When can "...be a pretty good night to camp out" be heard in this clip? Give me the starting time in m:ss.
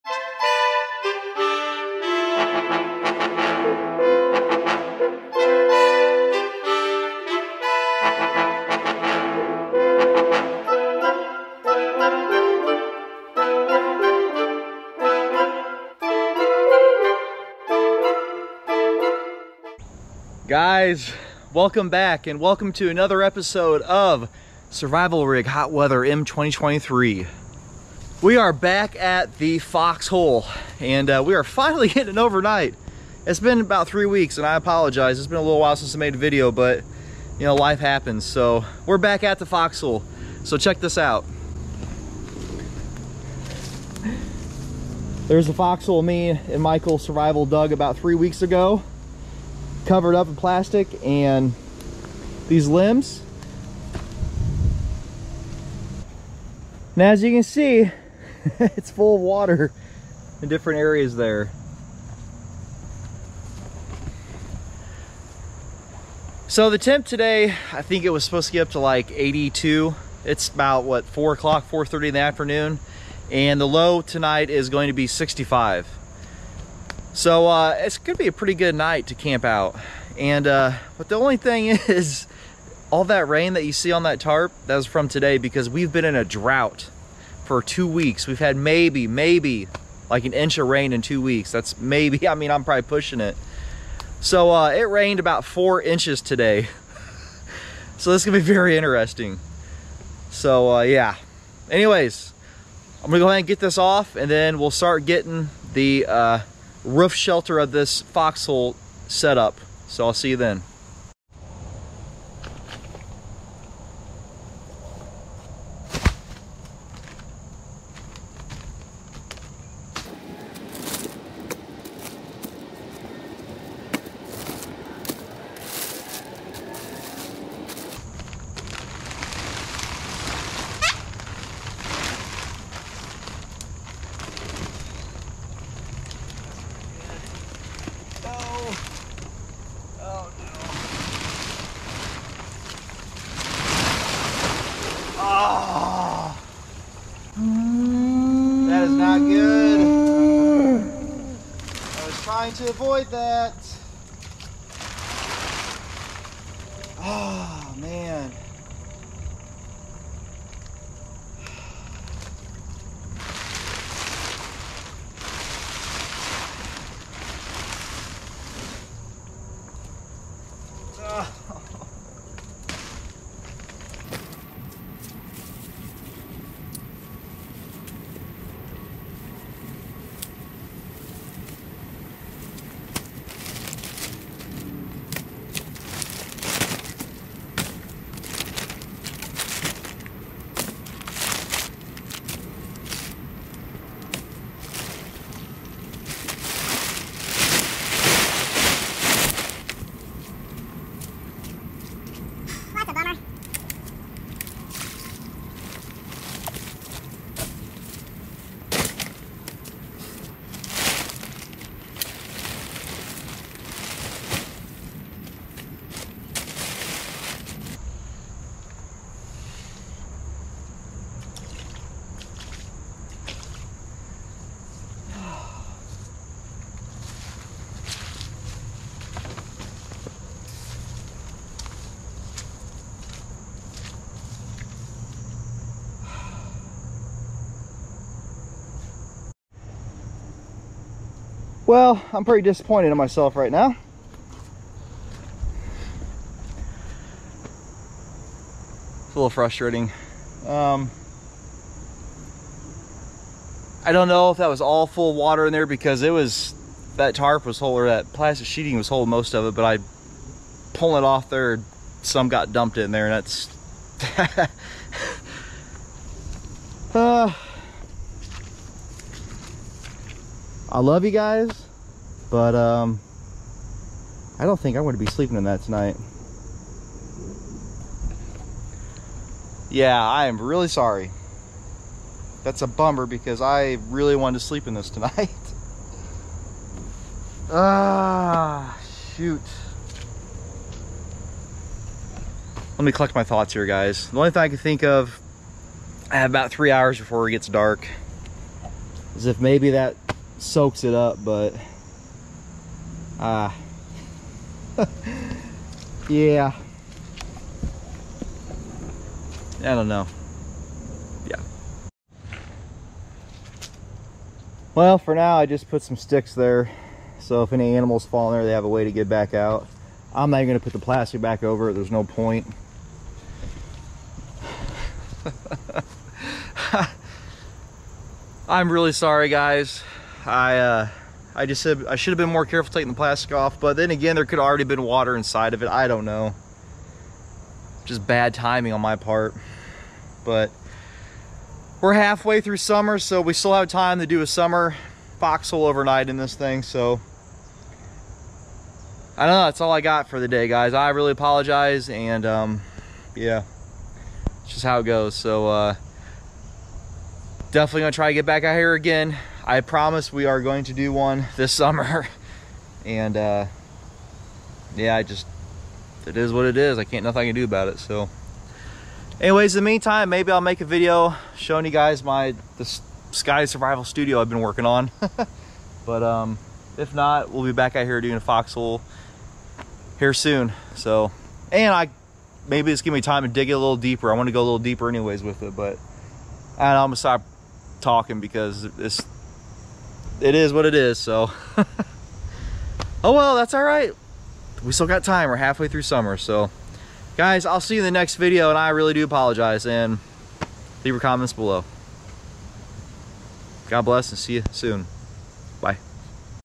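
1:18.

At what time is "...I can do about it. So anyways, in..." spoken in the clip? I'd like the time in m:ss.
6:07.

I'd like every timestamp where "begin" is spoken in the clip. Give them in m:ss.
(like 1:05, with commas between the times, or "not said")
not said.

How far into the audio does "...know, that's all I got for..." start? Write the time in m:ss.
5:49.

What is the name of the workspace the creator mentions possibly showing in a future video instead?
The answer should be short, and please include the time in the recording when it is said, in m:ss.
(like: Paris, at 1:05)
Scotty Survival Studio, at 6:13.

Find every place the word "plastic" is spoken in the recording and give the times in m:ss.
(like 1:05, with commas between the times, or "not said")
0:50, 4:18, 5:20, 5:32.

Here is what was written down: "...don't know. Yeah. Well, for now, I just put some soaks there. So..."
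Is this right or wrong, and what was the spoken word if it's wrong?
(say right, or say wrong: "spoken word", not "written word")
wrong: "sticks", not "soaks".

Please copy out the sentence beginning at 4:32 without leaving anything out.
But um, I don't think I want to be sleeping in that tonight.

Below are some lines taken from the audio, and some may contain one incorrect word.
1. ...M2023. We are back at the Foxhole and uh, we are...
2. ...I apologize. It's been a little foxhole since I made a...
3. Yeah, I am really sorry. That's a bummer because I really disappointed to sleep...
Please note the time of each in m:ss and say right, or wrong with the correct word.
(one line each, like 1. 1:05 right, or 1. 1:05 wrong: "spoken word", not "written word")
1. 0:26 right
2. 0:34 wrong: "while", not "foxhole"
3. 4:39 wrong: "wanted", not "disappointed".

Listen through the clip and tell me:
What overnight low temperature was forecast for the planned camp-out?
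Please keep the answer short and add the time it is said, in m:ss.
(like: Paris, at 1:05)
65, at 1:15.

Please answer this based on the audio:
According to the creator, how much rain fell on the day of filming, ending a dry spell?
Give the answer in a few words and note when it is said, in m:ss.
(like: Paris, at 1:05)
4 inches, at 1:35.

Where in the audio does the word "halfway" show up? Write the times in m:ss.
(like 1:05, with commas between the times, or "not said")
5:41, 6:35.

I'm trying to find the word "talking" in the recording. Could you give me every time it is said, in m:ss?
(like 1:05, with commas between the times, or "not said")
6:27.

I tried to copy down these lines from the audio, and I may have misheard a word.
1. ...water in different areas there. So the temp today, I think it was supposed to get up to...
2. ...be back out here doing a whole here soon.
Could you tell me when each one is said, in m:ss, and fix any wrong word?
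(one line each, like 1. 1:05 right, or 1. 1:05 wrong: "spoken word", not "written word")
1. 0:59 right
2. 6:17 wrong: "foxhole", not "whole".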